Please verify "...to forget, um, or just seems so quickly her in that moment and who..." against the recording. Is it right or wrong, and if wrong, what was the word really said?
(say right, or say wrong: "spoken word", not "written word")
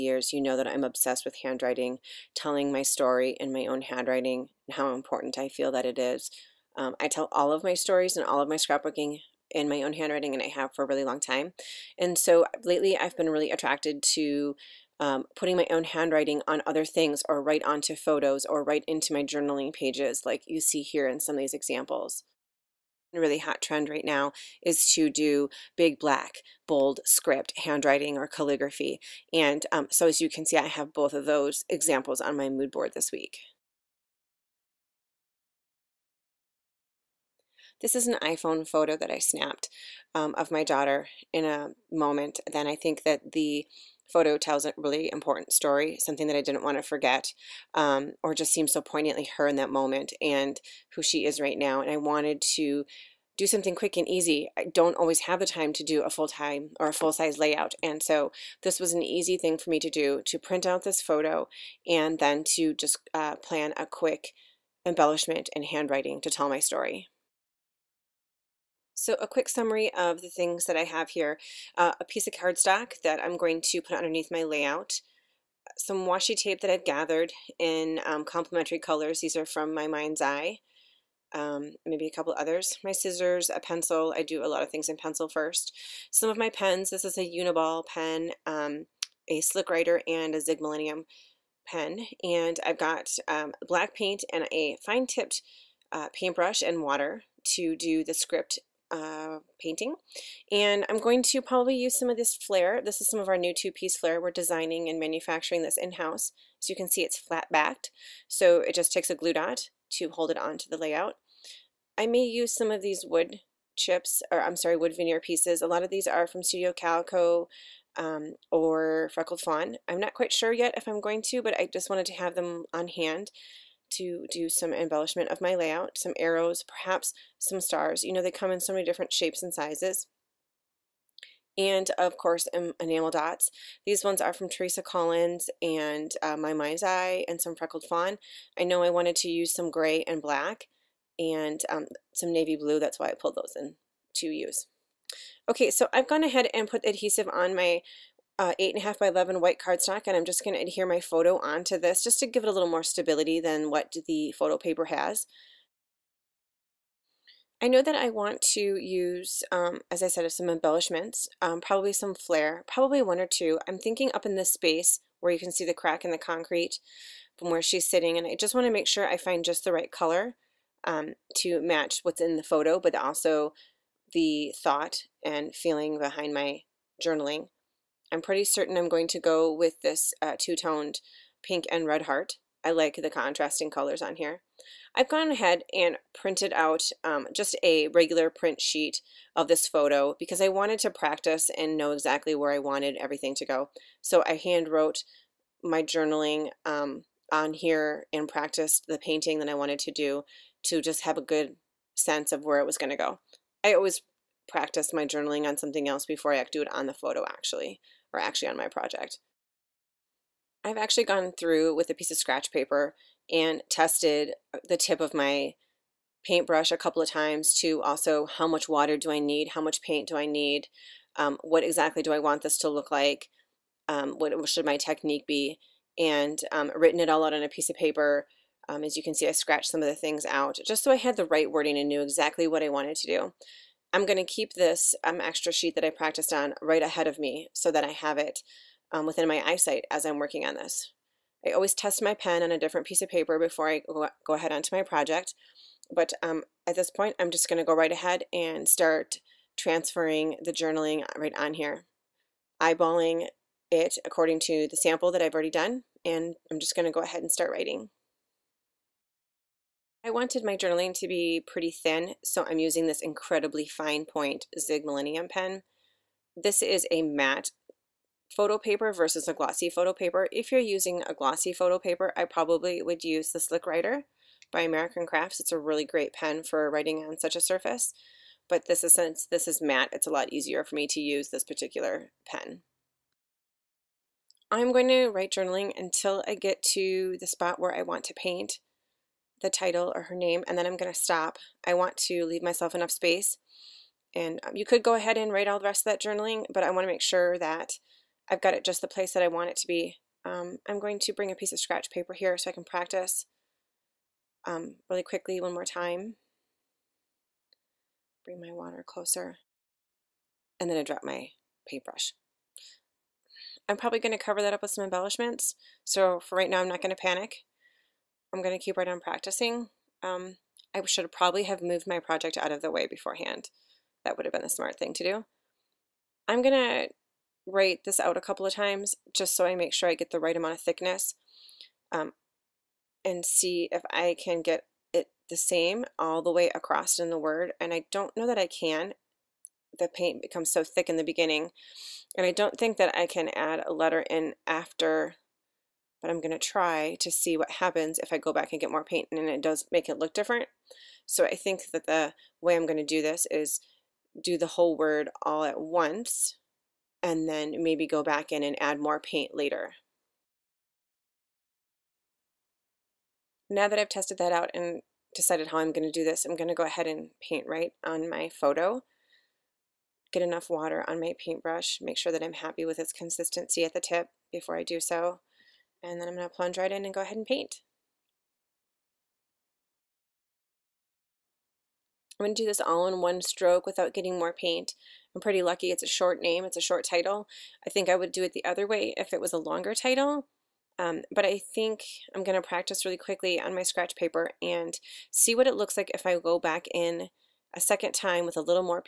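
wrong: "poignantly", not "quickly".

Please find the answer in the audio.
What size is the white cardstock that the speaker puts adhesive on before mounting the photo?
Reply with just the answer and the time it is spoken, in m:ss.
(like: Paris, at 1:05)
8.5 by 11, at 2:28.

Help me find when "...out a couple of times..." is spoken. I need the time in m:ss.
5:27.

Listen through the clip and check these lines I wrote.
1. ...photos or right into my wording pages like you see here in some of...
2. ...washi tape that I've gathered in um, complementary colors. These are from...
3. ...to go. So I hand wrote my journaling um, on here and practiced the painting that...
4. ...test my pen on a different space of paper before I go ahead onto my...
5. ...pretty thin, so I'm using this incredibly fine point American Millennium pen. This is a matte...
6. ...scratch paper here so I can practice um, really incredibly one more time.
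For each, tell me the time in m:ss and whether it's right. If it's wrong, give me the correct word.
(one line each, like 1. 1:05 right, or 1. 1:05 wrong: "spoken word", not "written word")
1. 0:17 wrong: "journaling", not "wording"
2. 1:16 right
3. 3:13 right
4. 4:01 wrong: "piece", not "space"
5. 4:21 wrong: "Zig", not "American"
6. 5:01 wrong: "quickly", not "incredibly".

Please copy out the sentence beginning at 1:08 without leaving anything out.
So a quick summary of the things that I have here.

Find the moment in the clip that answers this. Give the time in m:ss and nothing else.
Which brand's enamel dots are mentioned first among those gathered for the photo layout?
2:14.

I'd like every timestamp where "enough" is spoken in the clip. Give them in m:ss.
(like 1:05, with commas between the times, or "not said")
4:52, 6:10.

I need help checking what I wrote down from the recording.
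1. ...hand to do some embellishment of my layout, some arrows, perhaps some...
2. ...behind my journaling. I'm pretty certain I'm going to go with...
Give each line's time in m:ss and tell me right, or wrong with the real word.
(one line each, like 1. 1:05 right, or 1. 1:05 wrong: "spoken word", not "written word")
1. 2:02 right
2. 2:55 right.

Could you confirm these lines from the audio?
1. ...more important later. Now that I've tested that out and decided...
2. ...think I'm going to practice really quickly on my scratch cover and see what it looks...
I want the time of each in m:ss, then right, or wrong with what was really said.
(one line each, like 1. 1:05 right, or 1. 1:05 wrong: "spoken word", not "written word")
1. 5:58 wrong: "paint", not "important"
2. 6:31 wrong: "paper", not "cover".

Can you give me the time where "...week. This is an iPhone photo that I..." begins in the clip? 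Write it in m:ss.
0:33.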